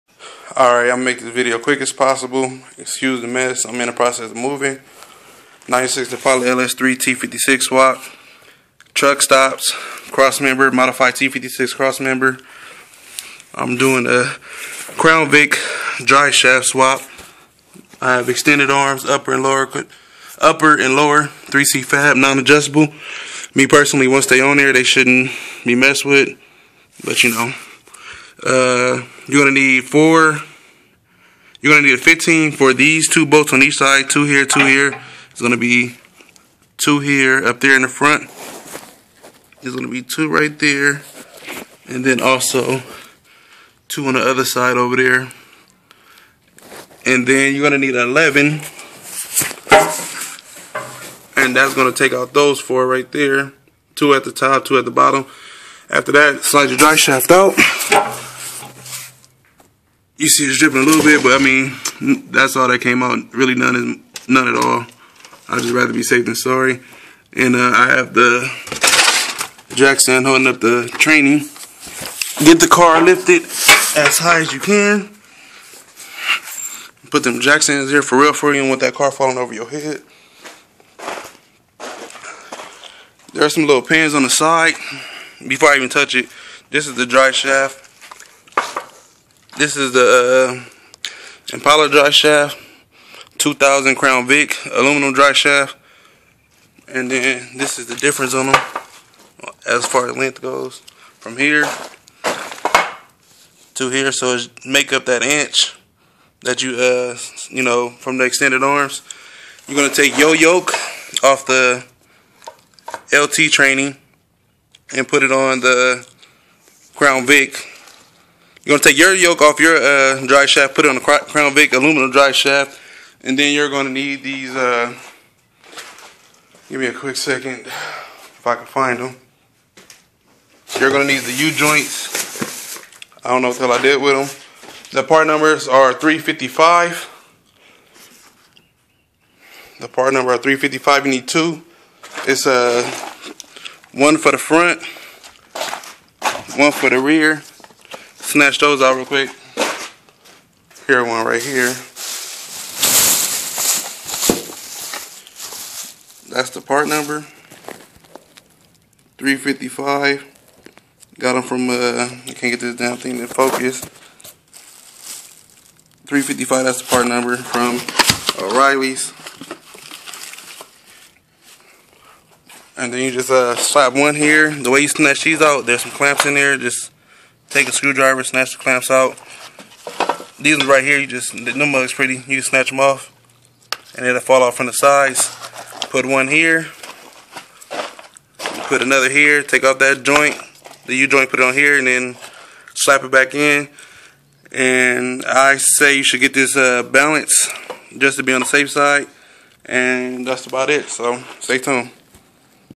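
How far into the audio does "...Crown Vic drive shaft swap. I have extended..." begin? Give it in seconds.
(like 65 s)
14 s.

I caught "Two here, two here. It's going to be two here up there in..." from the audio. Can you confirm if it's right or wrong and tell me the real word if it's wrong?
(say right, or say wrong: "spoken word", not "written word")
right.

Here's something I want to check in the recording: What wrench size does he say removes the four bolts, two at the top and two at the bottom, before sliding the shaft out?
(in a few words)
11.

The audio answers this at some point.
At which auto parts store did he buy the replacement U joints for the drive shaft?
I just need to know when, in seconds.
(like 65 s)
168 s.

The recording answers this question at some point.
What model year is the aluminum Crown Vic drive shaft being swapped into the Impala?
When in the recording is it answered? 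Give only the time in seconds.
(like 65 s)
93 s.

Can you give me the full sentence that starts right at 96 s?
And then this is the difference on them as far as length goes from here to here.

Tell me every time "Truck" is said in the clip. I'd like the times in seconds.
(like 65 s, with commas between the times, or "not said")
8 s.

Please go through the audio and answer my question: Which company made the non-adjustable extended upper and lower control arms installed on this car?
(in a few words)
3C fab.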